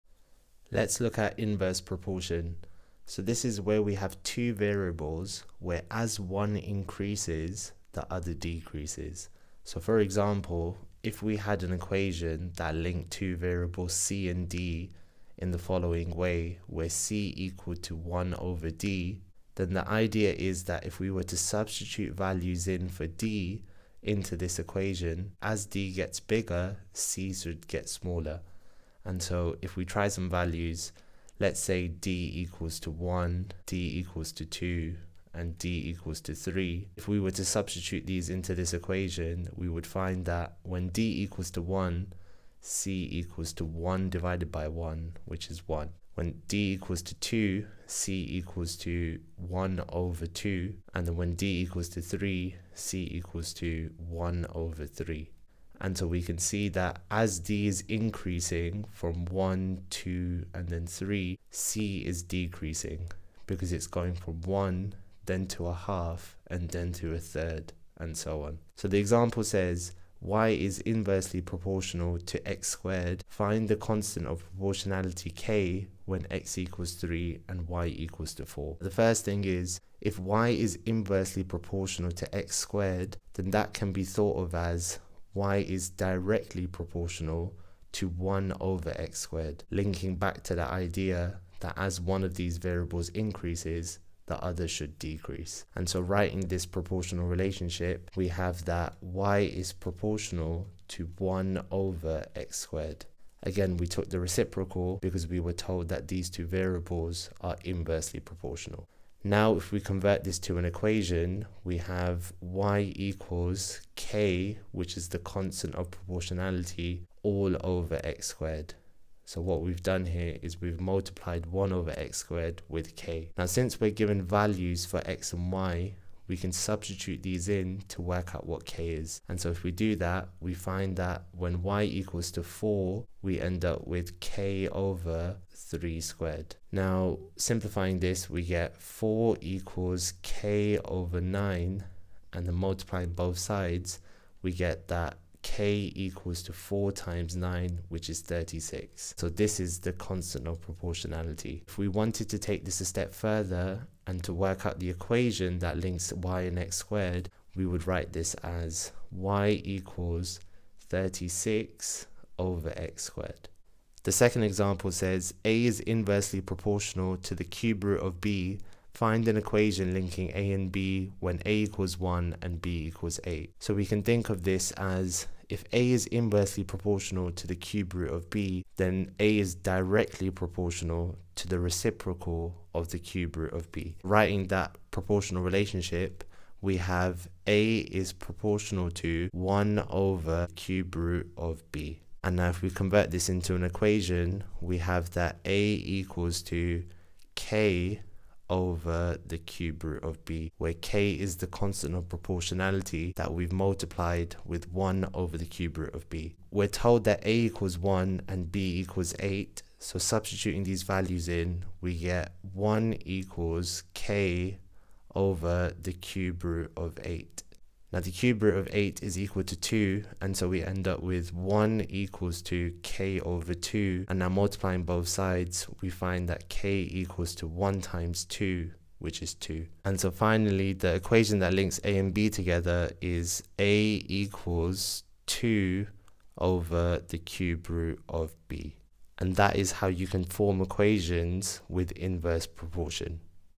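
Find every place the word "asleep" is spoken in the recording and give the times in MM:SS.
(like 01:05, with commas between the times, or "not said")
not said.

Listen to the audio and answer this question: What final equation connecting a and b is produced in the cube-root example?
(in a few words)
a = 2/∛b.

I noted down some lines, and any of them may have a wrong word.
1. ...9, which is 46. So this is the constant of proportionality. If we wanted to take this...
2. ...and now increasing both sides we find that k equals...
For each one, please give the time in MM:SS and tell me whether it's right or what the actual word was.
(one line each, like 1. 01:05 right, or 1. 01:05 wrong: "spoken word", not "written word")
1. 02:27 wrong: "36", not "46"
2. 03:44 wrong: "multiplying", not "increasing".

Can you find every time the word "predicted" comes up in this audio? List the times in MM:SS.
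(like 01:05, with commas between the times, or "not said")
not said.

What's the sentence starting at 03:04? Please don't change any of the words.
Writing that proportional relationship, we have a is proportional to 1 over cube root of b.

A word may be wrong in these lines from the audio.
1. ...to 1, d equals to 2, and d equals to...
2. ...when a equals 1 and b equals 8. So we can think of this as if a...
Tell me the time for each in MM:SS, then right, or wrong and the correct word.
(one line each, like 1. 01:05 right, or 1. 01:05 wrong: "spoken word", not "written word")
1. 00:32 right
2. 02:51 right.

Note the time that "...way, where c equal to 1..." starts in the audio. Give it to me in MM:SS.
00:16.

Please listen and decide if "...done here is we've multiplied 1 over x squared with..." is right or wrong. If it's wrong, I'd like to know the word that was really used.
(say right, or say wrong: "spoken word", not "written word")
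right.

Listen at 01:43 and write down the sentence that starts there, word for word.
Again, we took the reciprocal because we were told that these two variables are inversely proportional.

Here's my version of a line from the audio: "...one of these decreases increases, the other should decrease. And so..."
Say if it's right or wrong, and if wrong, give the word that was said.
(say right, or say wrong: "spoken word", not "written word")
wrong: "variables", not "decreases".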